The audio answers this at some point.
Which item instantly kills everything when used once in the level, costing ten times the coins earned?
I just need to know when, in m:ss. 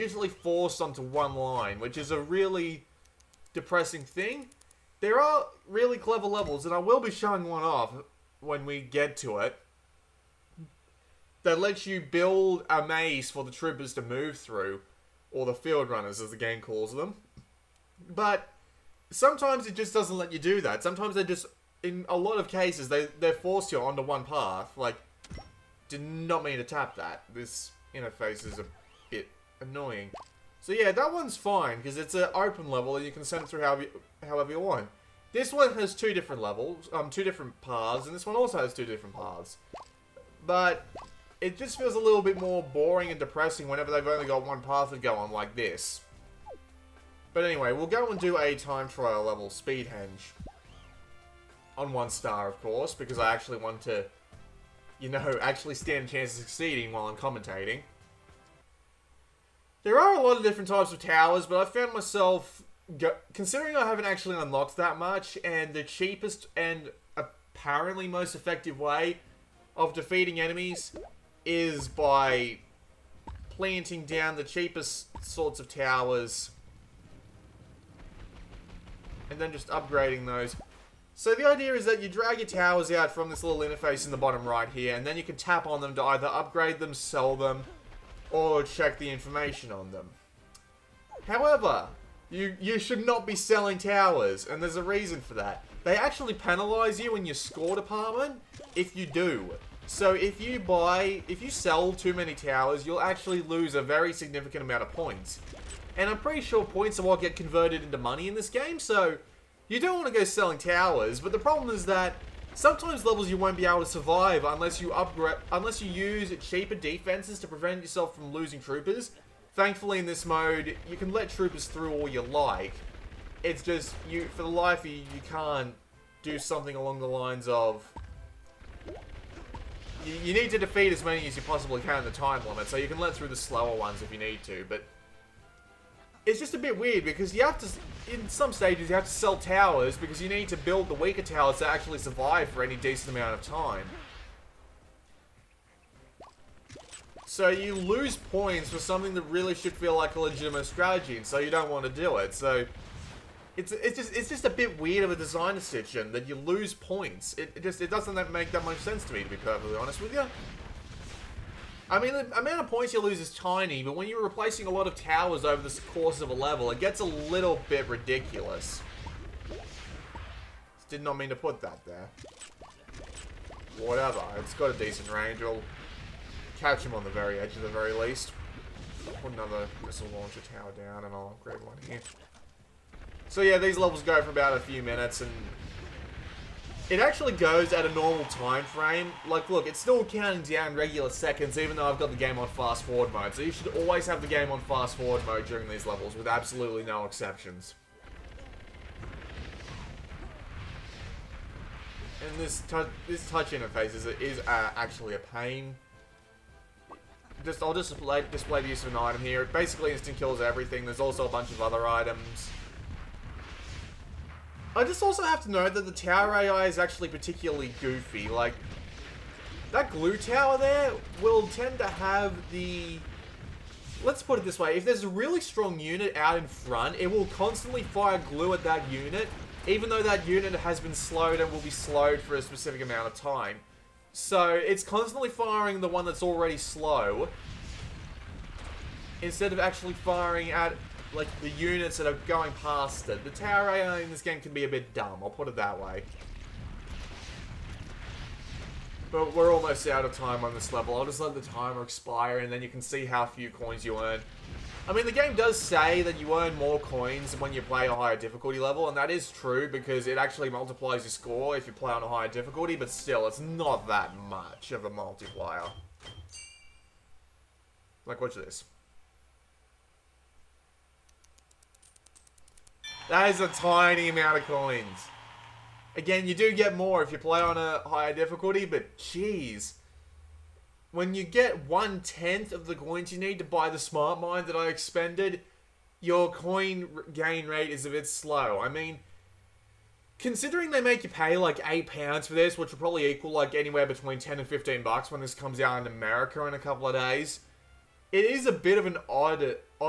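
4:43.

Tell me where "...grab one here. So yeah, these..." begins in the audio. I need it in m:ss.
3:01.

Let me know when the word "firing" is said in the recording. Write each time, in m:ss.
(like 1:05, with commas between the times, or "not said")
3:55, 3:59.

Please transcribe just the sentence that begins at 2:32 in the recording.
So it's it's just it's just a bit weird of a design decision that you lose points.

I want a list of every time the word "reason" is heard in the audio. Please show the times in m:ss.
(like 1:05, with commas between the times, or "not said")
1:34.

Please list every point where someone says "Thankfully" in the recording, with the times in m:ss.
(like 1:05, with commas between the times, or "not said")
1:59.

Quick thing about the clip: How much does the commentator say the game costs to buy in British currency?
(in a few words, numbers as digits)
8 pounds.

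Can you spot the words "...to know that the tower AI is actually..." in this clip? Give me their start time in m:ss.
3:35.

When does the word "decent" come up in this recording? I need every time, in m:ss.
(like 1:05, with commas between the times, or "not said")
2:22, 2:54.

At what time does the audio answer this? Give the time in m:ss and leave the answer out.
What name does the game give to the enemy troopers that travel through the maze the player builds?
0:15.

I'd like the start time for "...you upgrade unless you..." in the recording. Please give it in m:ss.
1:54.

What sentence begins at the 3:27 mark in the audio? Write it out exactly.
Just I'll just display, display the use of an item here.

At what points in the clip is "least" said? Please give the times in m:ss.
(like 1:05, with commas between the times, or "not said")
2:57.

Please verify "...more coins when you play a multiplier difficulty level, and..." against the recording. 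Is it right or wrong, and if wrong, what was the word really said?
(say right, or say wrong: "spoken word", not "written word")
wrong: "higher", not "multiplier".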